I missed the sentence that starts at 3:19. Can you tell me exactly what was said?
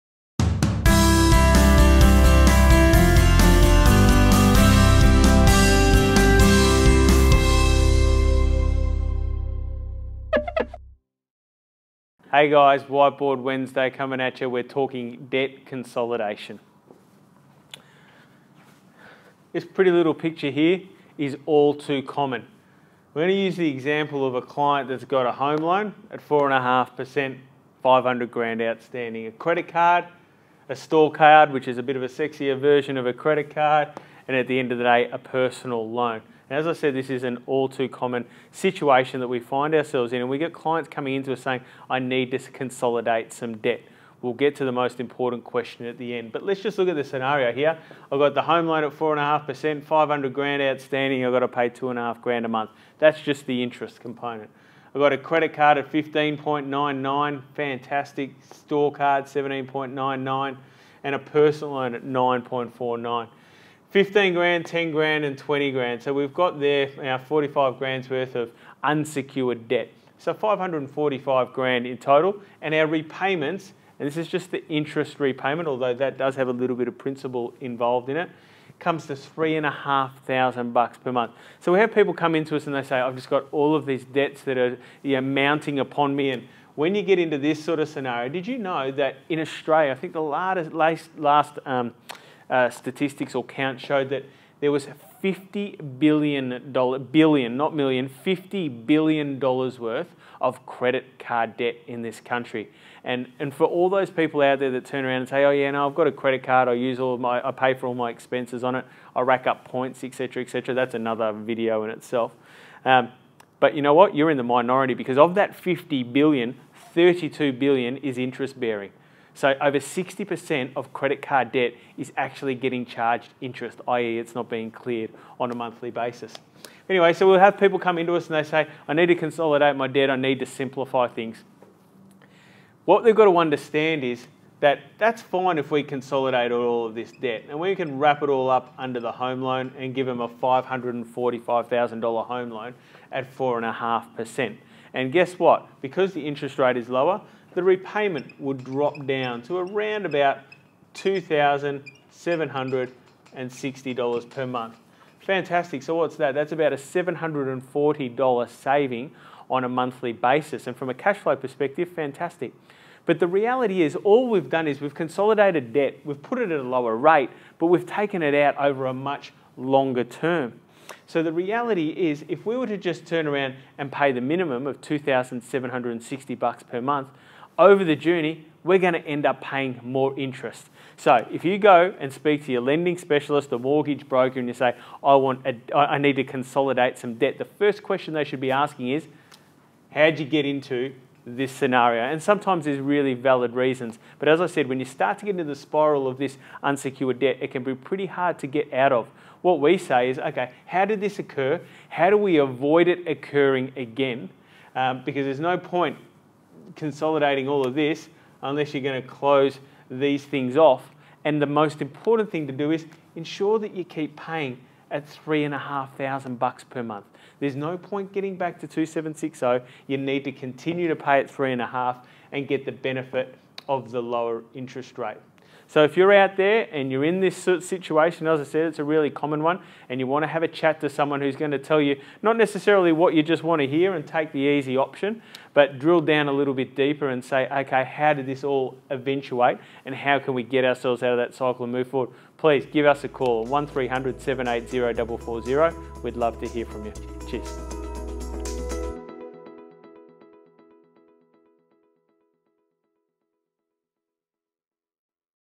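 What we say is, okay, how did this occur?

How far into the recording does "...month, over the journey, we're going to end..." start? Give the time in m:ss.
2:56.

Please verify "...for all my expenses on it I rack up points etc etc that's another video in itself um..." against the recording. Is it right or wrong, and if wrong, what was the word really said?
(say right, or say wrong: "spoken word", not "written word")
right.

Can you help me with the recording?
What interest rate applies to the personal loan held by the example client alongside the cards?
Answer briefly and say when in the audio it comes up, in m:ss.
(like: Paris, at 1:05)
9.49%, at 1:02.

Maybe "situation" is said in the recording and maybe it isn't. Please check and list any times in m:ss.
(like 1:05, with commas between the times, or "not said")
0:38, 3:47.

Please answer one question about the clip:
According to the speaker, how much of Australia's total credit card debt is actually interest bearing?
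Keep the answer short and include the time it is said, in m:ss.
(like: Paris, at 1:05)
32 billion, at 1:56.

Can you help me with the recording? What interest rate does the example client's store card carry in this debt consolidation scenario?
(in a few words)
17.99%.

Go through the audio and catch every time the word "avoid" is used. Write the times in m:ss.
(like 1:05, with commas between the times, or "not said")
3:22.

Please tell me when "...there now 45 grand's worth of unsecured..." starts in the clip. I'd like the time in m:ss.
1:06.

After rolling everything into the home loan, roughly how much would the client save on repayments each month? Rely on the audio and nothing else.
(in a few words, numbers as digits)
$740.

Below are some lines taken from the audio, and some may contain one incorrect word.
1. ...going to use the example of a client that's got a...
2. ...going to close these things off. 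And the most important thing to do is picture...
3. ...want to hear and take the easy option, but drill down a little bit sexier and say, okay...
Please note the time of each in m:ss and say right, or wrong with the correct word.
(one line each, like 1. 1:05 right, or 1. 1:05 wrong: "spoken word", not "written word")
1. 0:23 right
2. 3:28 wrong: "ensure", not "picture"
3. 3:53 wrong: "deeper", not "sexier".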